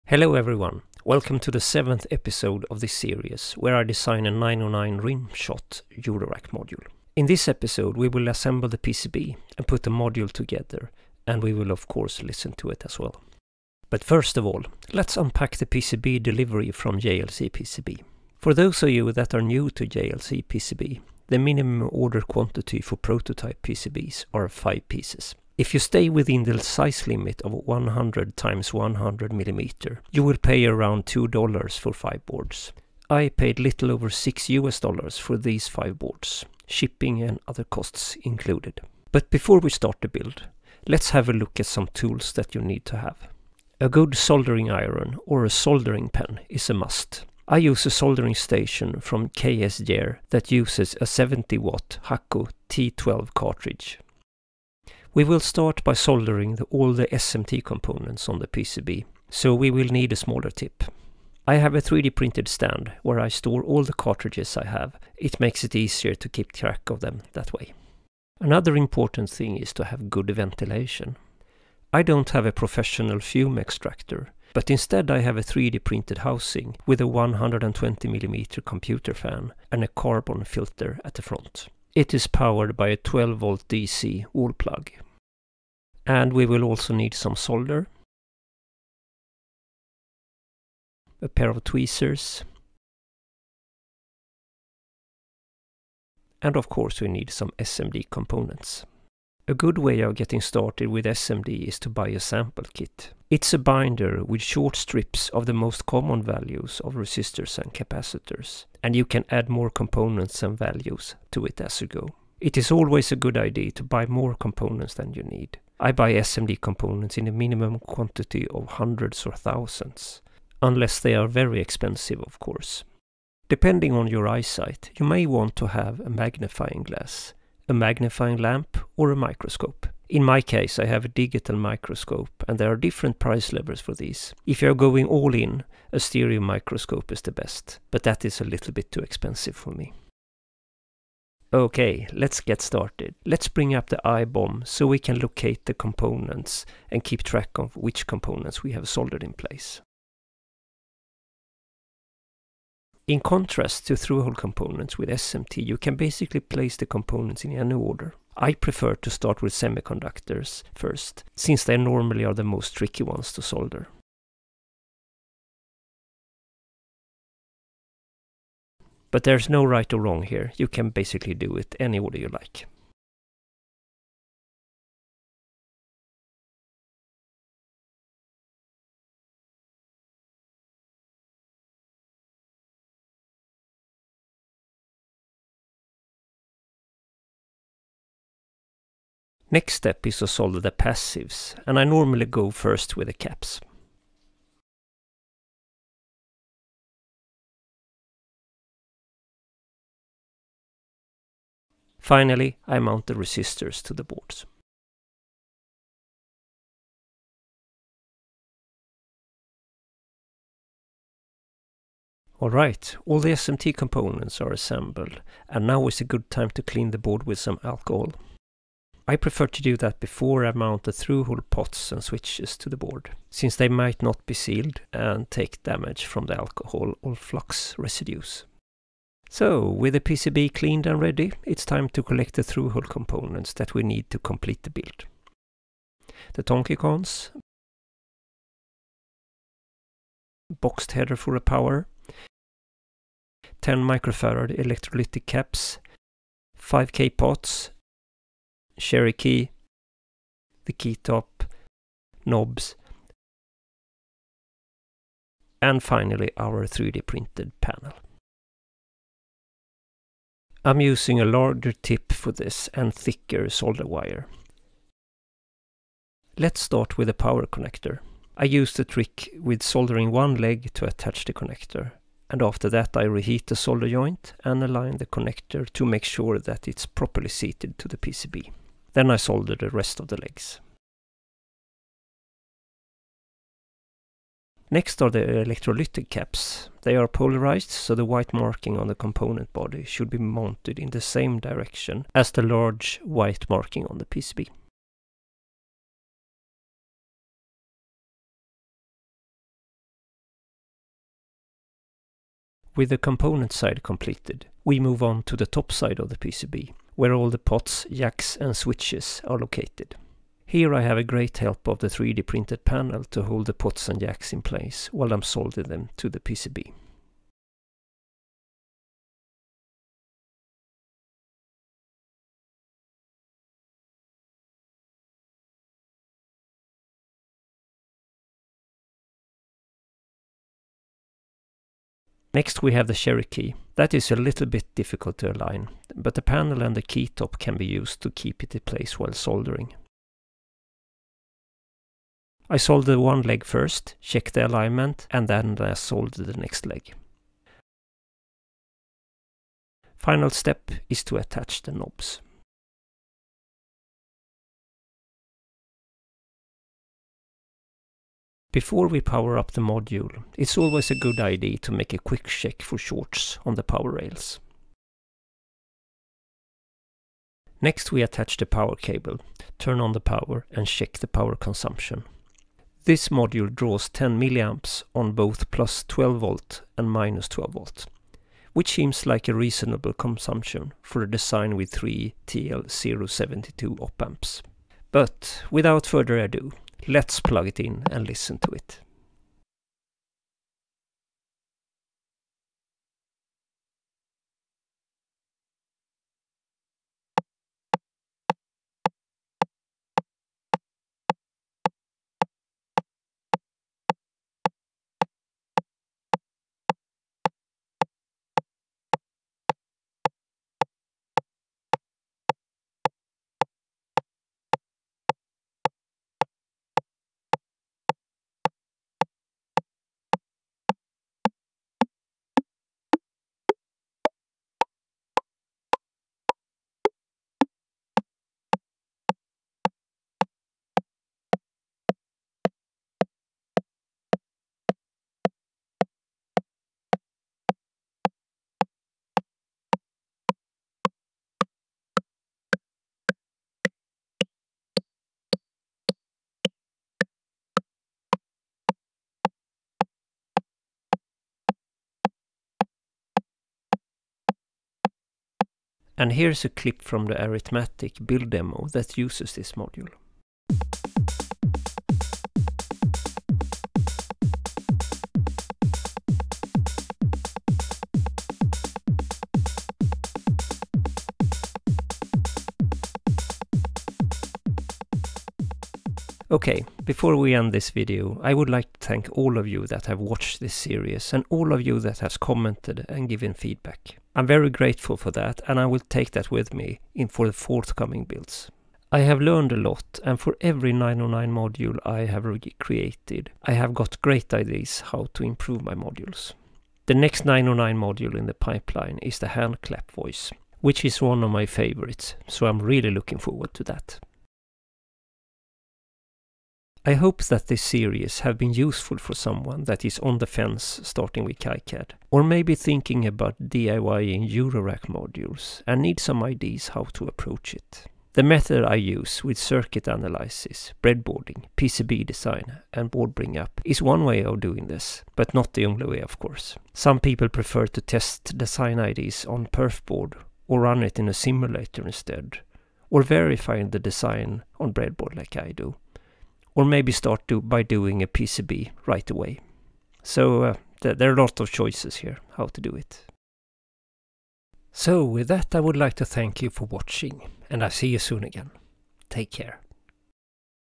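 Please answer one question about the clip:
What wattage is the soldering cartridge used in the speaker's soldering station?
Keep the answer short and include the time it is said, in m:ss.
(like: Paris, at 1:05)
70 watt, at 0:51.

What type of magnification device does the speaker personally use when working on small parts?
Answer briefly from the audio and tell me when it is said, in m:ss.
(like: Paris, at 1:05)
digital microscope, at 2:11.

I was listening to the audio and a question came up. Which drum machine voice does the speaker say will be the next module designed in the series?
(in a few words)
hand clap.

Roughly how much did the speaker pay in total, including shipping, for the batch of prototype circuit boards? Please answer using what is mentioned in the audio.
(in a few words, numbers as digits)
little over 6 US dollars.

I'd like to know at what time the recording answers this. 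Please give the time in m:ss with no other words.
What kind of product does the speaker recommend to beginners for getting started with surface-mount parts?
1:42.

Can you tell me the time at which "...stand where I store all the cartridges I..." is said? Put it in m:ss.
1:02.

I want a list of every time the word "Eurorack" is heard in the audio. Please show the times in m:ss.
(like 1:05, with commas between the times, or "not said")
0:06, 8:34.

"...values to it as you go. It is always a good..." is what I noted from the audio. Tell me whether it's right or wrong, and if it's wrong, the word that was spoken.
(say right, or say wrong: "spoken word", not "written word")
right.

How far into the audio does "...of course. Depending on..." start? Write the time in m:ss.
2:02.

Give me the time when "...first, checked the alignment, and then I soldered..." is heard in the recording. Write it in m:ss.
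5:43.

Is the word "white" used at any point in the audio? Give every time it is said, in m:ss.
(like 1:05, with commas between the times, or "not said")
4:48, 4:53.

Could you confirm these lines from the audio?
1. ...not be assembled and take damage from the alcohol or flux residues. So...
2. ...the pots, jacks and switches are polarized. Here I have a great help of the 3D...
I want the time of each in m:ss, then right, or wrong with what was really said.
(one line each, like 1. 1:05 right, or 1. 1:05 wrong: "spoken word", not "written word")
1. 3:44 wrong: "sealed", not "assembled"
2. 5:07 wrong: "located", not "polarized".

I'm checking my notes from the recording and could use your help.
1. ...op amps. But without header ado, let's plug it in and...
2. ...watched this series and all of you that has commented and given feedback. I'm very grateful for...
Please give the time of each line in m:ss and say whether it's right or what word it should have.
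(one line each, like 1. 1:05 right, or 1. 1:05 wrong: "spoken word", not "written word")
1. 6:23 wrong: "further", not "header"
2. 7:59 right.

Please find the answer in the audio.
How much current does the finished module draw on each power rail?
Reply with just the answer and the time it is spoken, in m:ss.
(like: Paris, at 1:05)
10 milliamps, at 6:13.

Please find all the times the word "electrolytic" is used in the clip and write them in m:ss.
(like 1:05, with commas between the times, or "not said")
4:04, 4:45.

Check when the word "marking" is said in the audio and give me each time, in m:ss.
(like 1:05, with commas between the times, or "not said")
4:48, 4:53.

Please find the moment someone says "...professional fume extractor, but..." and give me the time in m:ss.
1:12.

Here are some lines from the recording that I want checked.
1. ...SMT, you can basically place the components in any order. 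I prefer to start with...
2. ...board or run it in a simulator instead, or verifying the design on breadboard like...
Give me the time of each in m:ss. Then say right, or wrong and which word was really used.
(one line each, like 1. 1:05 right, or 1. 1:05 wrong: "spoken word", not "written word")
1. 2:35 right
2. 8:49 right.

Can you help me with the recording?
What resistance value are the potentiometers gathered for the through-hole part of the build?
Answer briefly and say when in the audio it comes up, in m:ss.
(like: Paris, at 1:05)
5k, at 4:06.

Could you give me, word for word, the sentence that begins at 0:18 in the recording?
For those of you that are new to JLC PCB, the minimum order quantity for prototype PCBs are 5 pieces.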